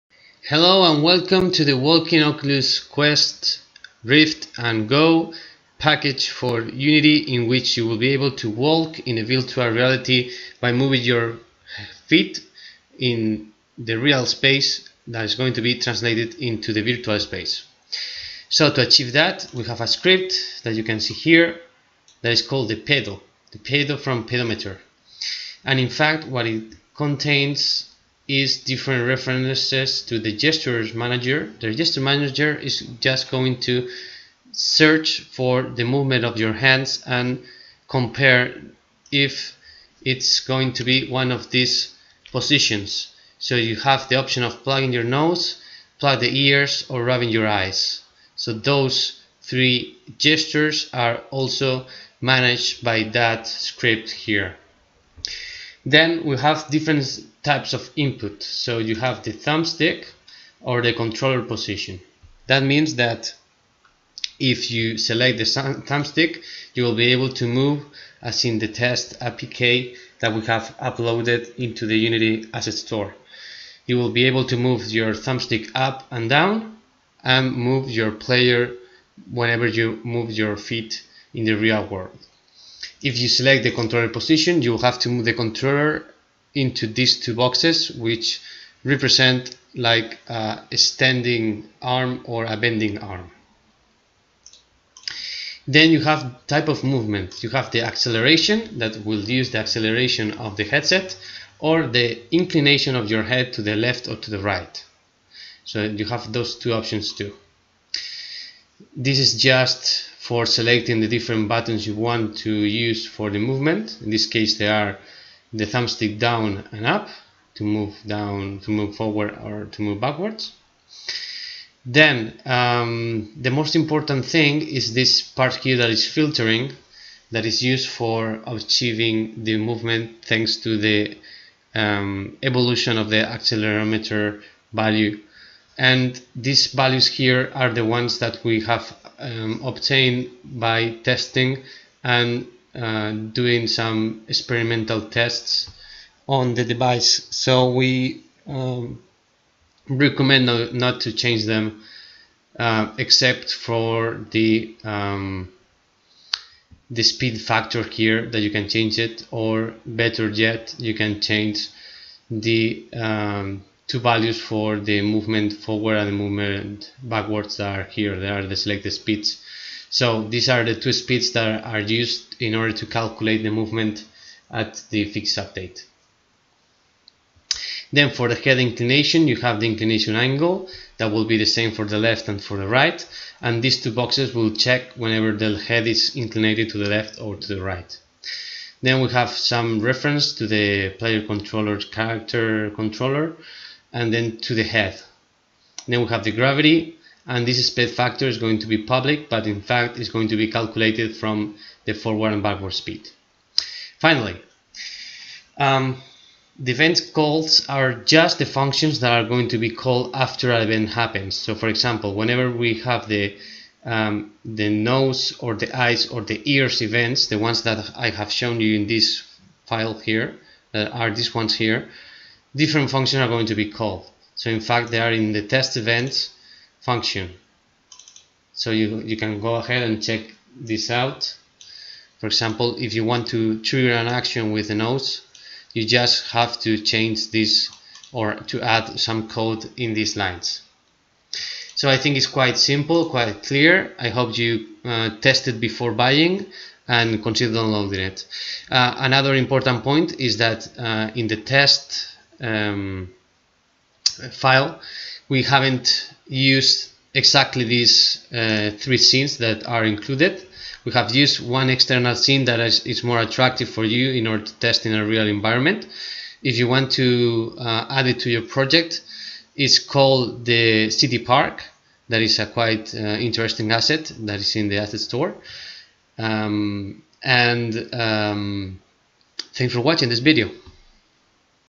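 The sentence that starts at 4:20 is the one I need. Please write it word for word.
We have used one external scene that is, is, more attractive for you in order to test in a real environment.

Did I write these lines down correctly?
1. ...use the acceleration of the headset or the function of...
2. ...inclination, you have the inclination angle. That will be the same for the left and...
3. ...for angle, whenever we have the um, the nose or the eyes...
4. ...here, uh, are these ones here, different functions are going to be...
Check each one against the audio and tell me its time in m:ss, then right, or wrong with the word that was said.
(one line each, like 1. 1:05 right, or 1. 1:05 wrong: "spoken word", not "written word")
1. 1:39 wrong: "inclination", not "function"
2. 2:58 right
3. 3:31 wrong: "example", not "angle"
4. 3:39 right.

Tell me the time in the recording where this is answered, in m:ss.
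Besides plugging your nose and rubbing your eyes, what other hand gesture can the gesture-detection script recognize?
0:45.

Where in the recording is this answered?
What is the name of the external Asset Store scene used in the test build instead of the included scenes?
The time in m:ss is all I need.
4:30.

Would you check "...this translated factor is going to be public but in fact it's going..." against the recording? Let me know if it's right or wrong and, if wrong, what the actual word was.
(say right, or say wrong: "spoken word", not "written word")
wrong: "speed", not "translated".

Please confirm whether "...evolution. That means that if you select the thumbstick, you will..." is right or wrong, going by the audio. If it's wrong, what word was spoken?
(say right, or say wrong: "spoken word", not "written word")
wrong: "position", not "evolution".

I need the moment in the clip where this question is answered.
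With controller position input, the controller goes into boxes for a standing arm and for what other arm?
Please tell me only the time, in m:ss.
1:32.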